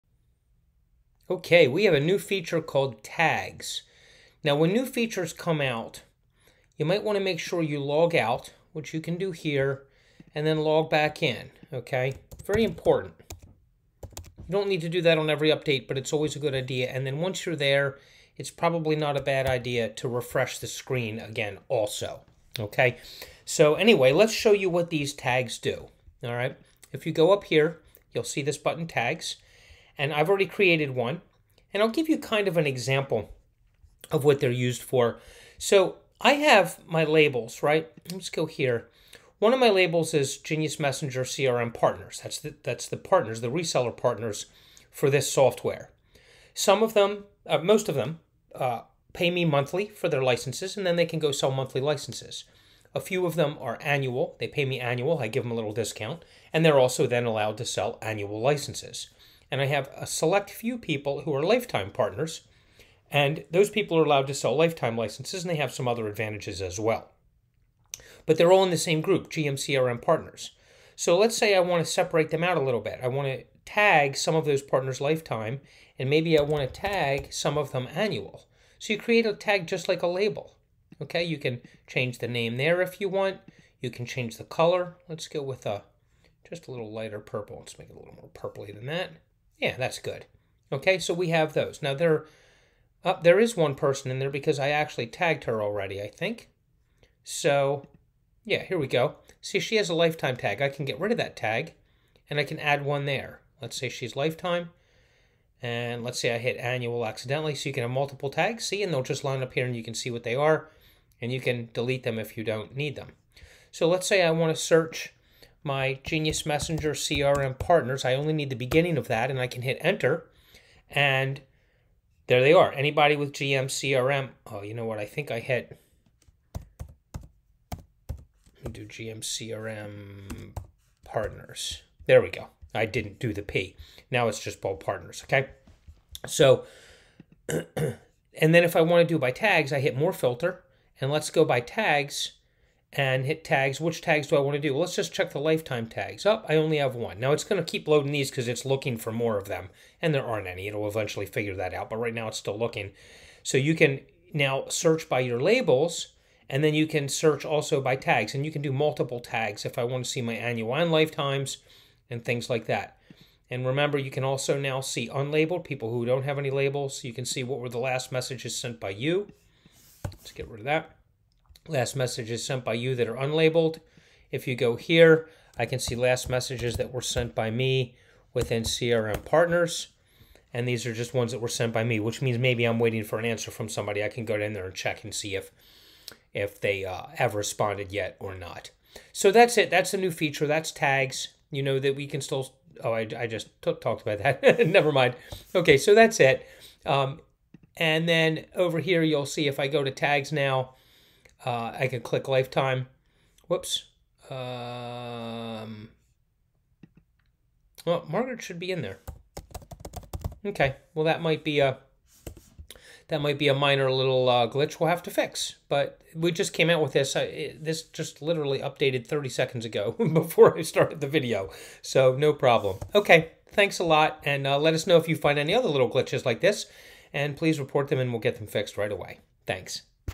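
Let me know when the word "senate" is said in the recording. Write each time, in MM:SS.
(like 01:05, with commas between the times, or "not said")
not said.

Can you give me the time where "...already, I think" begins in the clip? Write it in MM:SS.
01:35.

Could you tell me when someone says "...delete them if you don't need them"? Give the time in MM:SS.
01:51.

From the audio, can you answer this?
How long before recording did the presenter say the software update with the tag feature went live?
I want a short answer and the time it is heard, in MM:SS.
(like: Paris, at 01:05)
30 seconds, at 03:39.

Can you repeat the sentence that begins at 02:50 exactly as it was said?
Let's get rid of that last messages sent by you that are unlabeled.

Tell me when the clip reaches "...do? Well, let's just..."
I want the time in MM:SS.
02:24.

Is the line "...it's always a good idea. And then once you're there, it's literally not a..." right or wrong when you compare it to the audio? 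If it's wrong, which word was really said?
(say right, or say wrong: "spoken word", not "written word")
wrong: "probably", not "literally".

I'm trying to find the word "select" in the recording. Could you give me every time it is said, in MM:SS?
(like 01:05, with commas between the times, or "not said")
01:00.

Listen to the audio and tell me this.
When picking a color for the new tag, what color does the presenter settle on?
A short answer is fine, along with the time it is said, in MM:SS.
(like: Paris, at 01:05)
lighter purple, at 01:26.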